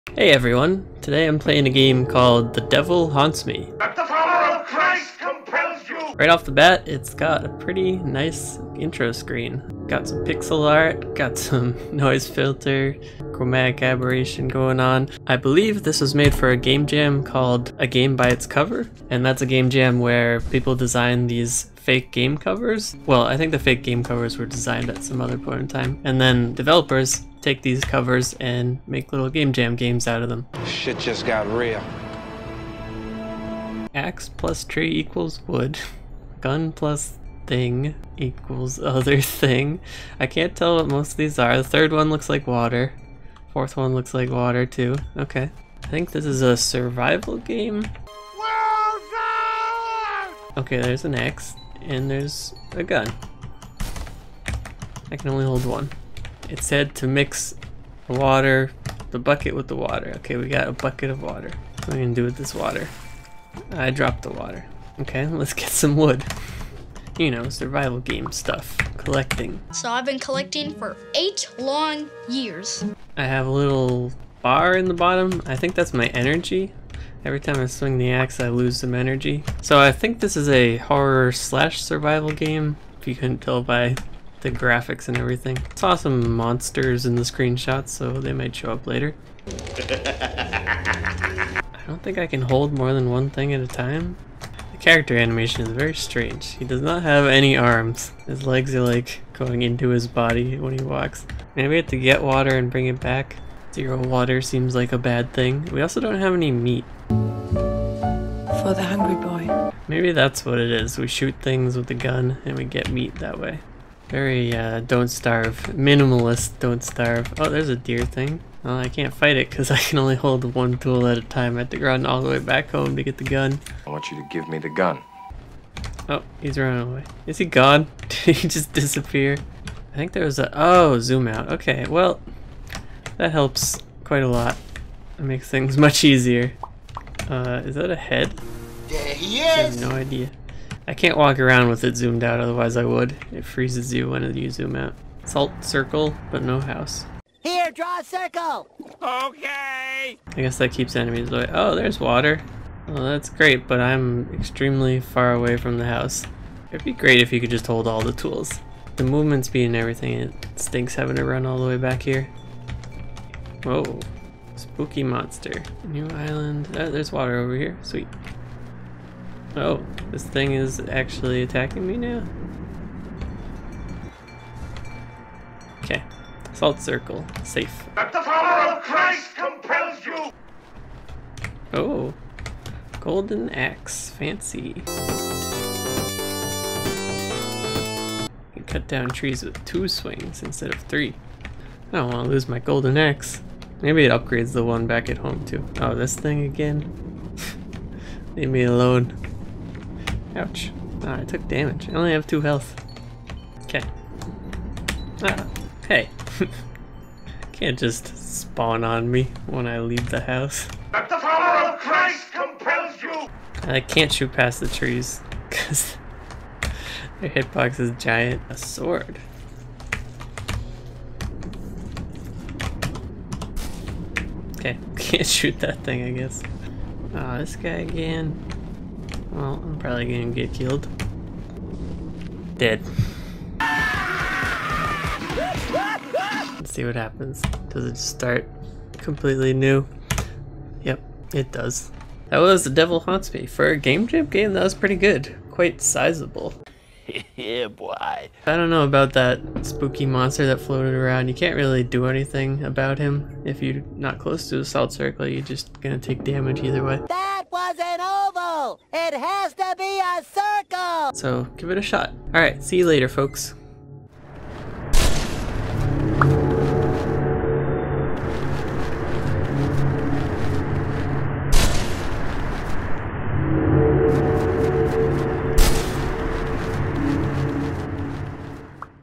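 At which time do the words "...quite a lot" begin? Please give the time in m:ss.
2:14.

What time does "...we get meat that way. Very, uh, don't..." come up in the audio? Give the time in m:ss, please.
1:52.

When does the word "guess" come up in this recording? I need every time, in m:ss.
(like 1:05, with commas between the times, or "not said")
2:30, 3:46.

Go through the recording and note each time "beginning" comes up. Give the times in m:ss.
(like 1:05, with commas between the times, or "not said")
not said.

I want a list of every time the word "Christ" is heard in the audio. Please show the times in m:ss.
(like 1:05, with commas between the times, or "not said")
2:58, 3:31.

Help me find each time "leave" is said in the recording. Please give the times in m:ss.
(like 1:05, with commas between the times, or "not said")
3:18, 3:29.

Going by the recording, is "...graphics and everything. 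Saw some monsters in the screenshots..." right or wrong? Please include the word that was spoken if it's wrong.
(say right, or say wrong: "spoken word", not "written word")
right.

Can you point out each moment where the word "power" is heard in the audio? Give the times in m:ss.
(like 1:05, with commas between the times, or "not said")
2:58, 3:31.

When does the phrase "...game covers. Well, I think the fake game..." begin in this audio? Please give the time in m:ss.
0:22.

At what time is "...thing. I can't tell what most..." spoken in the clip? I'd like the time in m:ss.
0:39.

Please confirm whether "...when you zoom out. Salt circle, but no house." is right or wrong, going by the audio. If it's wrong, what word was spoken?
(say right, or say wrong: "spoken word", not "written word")
right.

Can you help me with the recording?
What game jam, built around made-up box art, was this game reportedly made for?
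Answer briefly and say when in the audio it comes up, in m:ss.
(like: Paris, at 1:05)
A Game by Its Cover, at 0:17.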